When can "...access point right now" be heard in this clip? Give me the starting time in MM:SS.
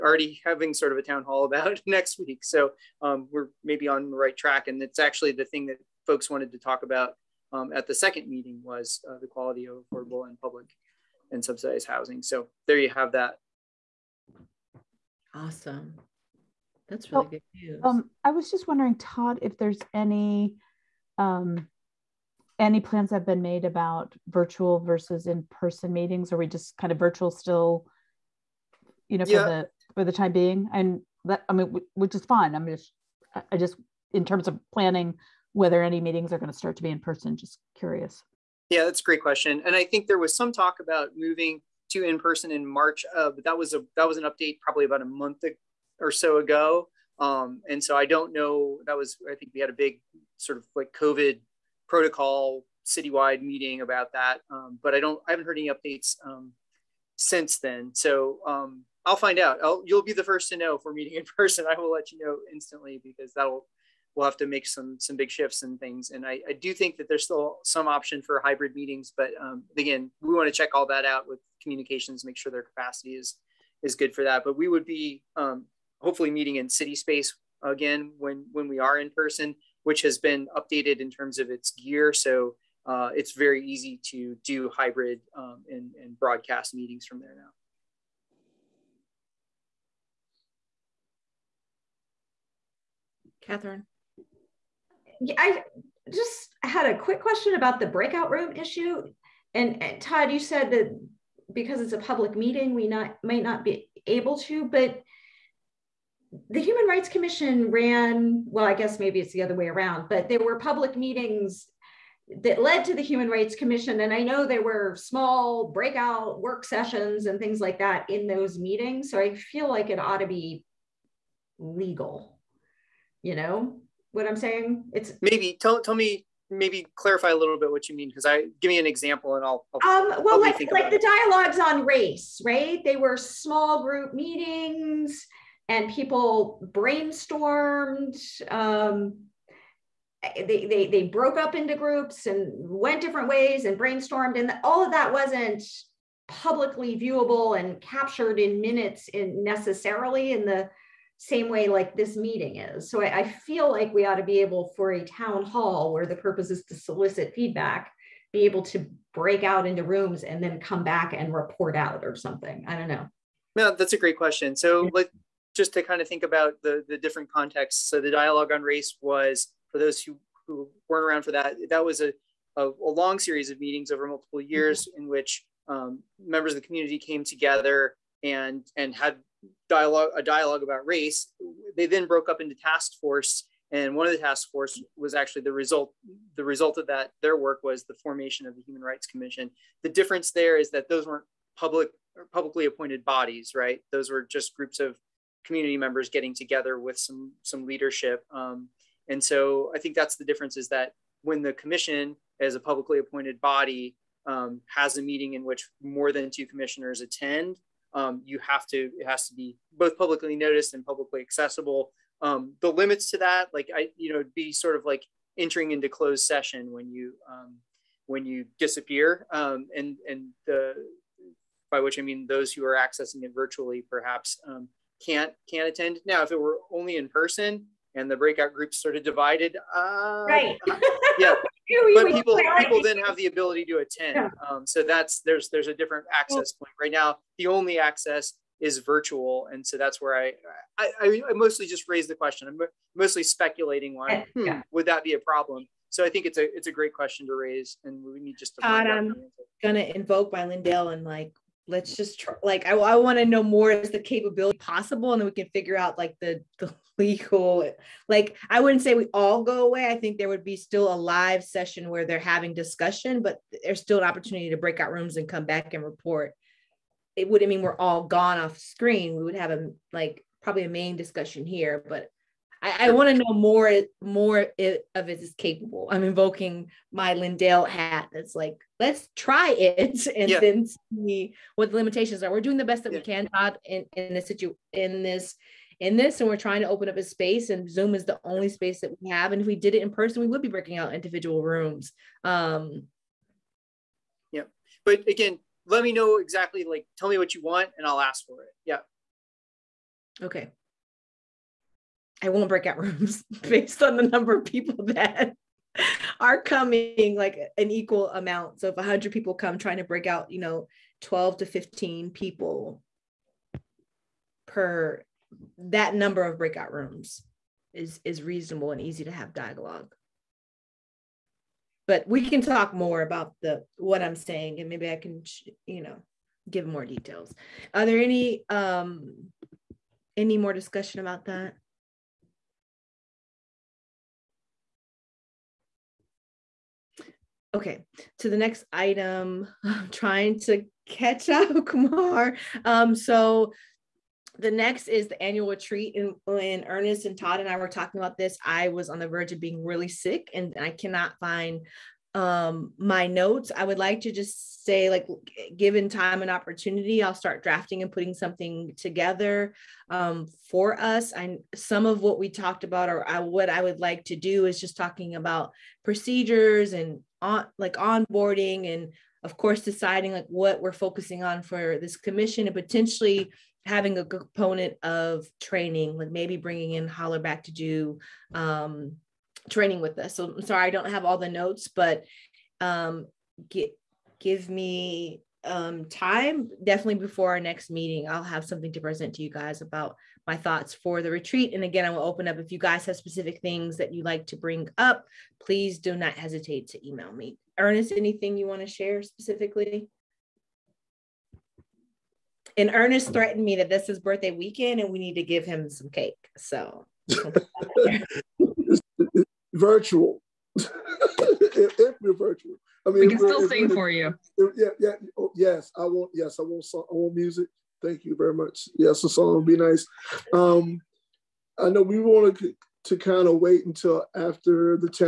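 03:56.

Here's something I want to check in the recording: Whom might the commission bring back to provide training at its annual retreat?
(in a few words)
Holler.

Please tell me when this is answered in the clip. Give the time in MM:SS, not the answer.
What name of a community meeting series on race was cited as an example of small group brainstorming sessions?
02:10.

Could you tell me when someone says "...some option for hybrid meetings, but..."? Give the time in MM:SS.
01:07.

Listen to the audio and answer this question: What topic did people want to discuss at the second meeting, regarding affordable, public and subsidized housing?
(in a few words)
quality.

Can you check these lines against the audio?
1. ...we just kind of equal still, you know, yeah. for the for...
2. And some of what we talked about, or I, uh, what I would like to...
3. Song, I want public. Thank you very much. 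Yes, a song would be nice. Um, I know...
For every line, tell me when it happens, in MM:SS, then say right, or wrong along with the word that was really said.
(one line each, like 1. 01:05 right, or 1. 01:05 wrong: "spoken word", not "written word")
1. 00:26 wrong: "virtual", not "equal"
2. 06:01 right
3. 06:56 wrong: "music", not "public".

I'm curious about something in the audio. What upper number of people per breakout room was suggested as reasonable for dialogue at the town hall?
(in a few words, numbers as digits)
15.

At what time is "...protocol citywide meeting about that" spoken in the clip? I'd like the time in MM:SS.
00:51.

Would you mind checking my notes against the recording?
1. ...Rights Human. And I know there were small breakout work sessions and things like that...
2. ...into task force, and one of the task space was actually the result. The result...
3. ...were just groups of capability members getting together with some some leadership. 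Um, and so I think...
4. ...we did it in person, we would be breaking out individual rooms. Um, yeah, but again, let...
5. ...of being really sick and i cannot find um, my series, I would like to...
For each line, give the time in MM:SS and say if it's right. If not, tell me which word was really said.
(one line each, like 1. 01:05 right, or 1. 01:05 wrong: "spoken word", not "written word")
1. 01:53 wrong: "Commission", not "Human"
2. 03:02 wrong: "force", not "space"
3. 03:14 wrong: "community", not "capability"
4. 04:49 right
5. 05:49 wrong: "notes", not "series".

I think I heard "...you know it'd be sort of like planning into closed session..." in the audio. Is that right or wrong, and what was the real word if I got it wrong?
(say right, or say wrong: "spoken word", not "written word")
wrong: "entering", not "planning".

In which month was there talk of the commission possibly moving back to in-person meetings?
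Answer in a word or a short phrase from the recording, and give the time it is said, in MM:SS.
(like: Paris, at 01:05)
March, at 00:42.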